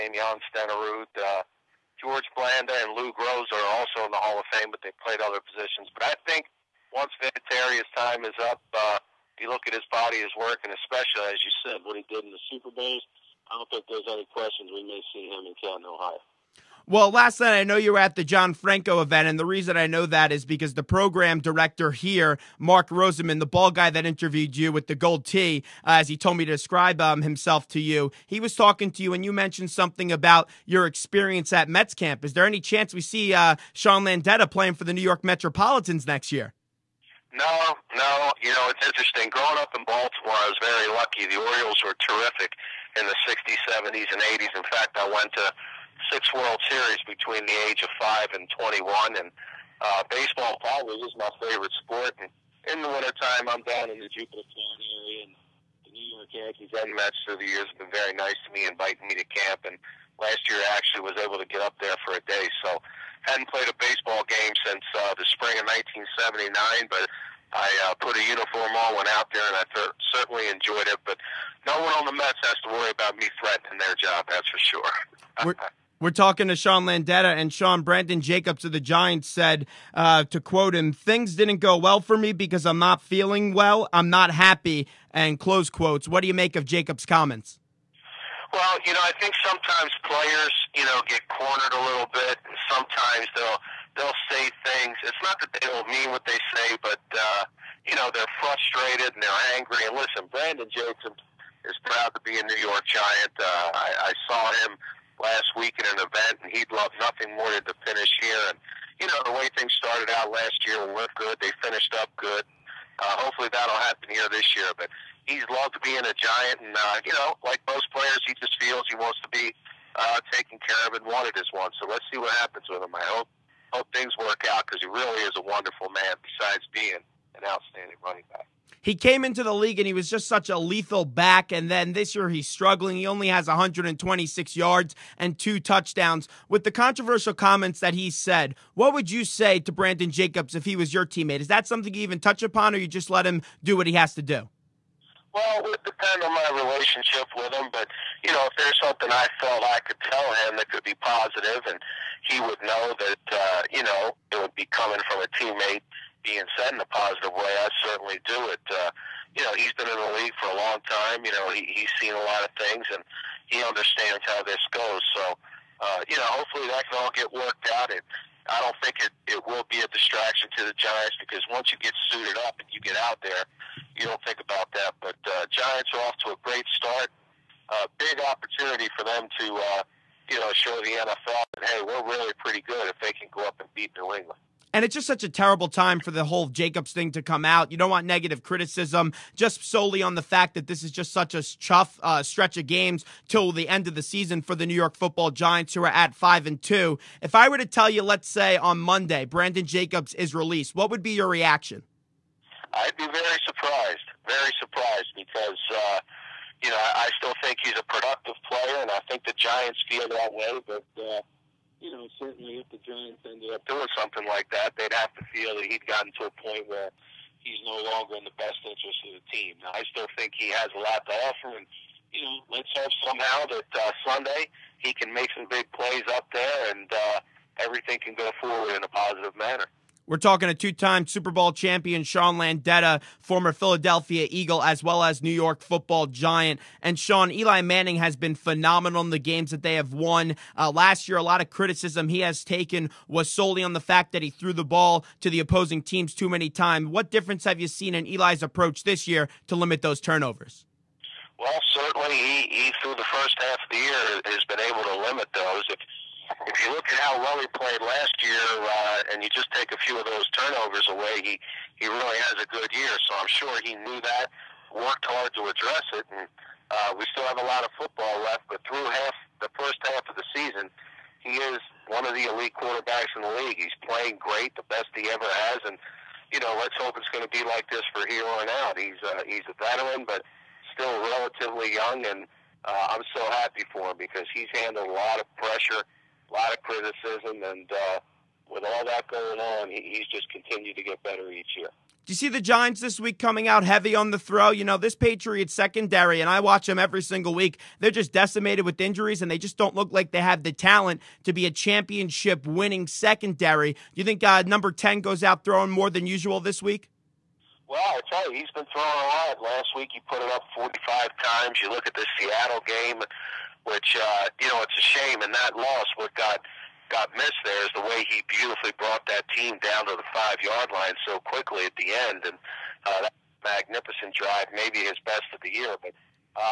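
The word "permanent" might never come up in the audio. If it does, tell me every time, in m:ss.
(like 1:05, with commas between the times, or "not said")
not said.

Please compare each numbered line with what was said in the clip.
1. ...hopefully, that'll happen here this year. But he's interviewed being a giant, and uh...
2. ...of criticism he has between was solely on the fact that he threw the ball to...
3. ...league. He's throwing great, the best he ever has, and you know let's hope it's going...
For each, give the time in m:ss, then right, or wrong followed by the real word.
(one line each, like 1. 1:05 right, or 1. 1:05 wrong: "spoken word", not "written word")
1. 1:53 wrong: "loved", not "interviewed"
2. 4:01 wrong: "taken", not "between"
3. 4:33 wrong: "playing", not "throwing".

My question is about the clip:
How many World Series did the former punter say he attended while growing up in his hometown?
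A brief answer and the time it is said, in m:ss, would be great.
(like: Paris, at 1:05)
6, at 0:46.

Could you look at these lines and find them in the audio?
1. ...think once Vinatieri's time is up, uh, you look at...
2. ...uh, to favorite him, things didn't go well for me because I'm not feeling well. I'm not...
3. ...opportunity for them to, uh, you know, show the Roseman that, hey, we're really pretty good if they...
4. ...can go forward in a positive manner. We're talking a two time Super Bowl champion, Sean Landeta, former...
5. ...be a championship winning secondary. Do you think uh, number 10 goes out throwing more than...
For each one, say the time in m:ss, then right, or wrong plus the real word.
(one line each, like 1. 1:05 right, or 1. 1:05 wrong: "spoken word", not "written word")
1. 0:06 right
2. 1:19 wrong: "quote", not "favorite"
3. 2:58 wrong: "NFL", not "Roseman"
4. 3:48 right
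5. 5:01 right.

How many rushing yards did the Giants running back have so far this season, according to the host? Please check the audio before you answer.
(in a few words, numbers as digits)
126.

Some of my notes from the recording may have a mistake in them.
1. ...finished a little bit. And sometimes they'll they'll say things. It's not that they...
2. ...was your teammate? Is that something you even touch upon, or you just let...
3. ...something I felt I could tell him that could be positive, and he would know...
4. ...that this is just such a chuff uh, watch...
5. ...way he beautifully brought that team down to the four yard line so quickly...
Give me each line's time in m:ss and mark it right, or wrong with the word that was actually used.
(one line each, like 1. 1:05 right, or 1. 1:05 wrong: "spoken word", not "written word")
1. 1:31 wrong: "cornered", not "finished"
2. 2:20 right
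3. 2:28 right
4. 3:10 wrong: "stretch", not "watch"
5. 5:17 wrong: "five", not "four".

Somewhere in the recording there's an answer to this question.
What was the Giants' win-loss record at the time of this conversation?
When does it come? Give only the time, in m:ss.
3:16.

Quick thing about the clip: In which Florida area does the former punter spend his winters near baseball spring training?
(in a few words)
Jupiter, Florida.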